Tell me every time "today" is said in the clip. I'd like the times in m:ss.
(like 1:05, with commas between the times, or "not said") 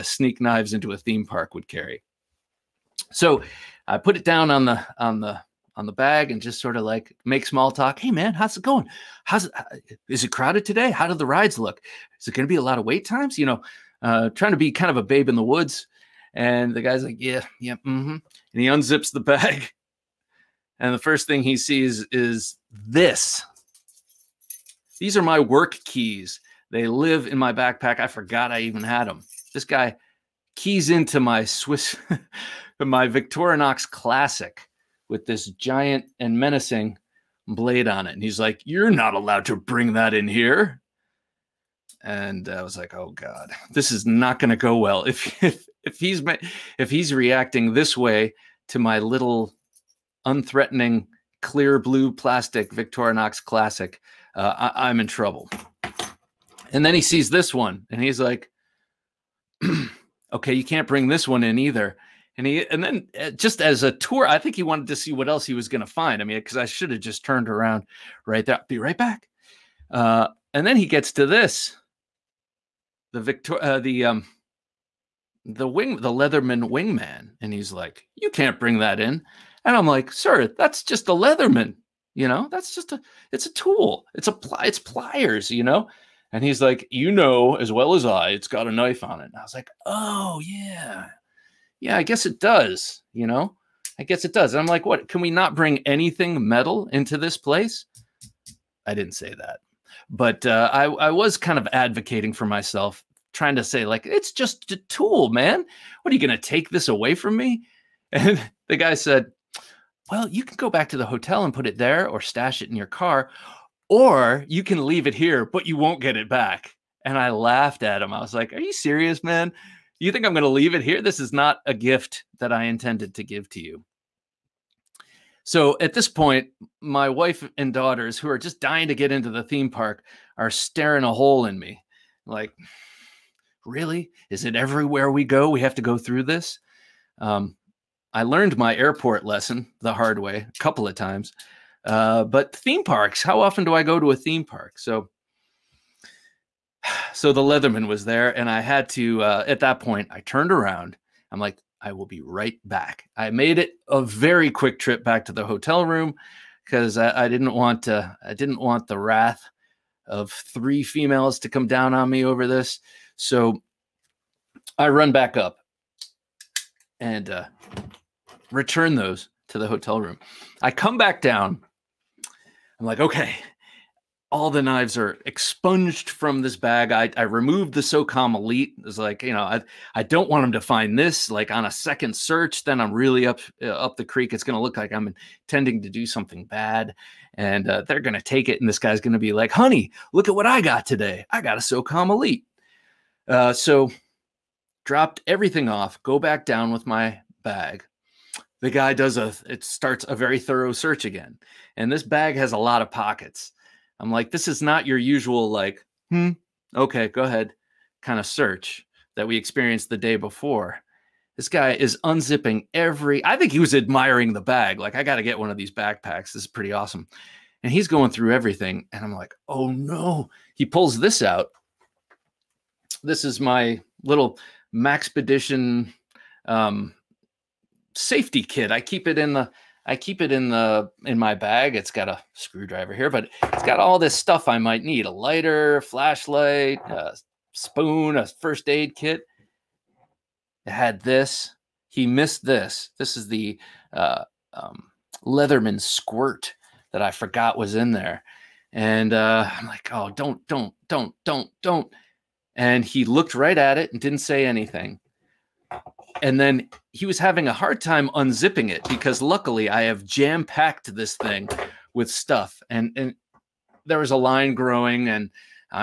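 0:10, 3:10.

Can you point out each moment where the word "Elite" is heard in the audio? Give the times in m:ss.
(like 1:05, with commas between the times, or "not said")
2:58, 3:12.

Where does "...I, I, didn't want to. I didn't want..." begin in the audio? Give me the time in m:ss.
2:36.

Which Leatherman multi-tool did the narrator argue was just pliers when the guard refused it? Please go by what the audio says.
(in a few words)
Leatherman Wingman.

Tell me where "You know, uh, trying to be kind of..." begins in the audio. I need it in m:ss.
0:13.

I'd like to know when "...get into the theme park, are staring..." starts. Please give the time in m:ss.
2:08.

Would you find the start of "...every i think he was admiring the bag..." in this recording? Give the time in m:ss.
3:32.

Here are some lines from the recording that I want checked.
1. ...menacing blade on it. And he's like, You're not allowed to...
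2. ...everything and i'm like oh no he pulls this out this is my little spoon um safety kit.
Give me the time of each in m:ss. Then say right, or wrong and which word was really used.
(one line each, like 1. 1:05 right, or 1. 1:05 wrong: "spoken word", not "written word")
1. 0:36 right
2. 3:38 wrong: "maxpedition", not "spoon".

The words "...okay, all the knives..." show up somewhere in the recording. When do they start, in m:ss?
2:53.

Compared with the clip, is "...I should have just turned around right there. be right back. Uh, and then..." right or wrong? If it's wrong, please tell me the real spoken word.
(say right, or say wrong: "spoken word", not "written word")
right.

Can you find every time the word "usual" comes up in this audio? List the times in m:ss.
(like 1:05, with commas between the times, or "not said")
3:24.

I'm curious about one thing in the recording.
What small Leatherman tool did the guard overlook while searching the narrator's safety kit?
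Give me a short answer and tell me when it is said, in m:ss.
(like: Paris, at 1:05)
Leatherman Squirt, at 4:05.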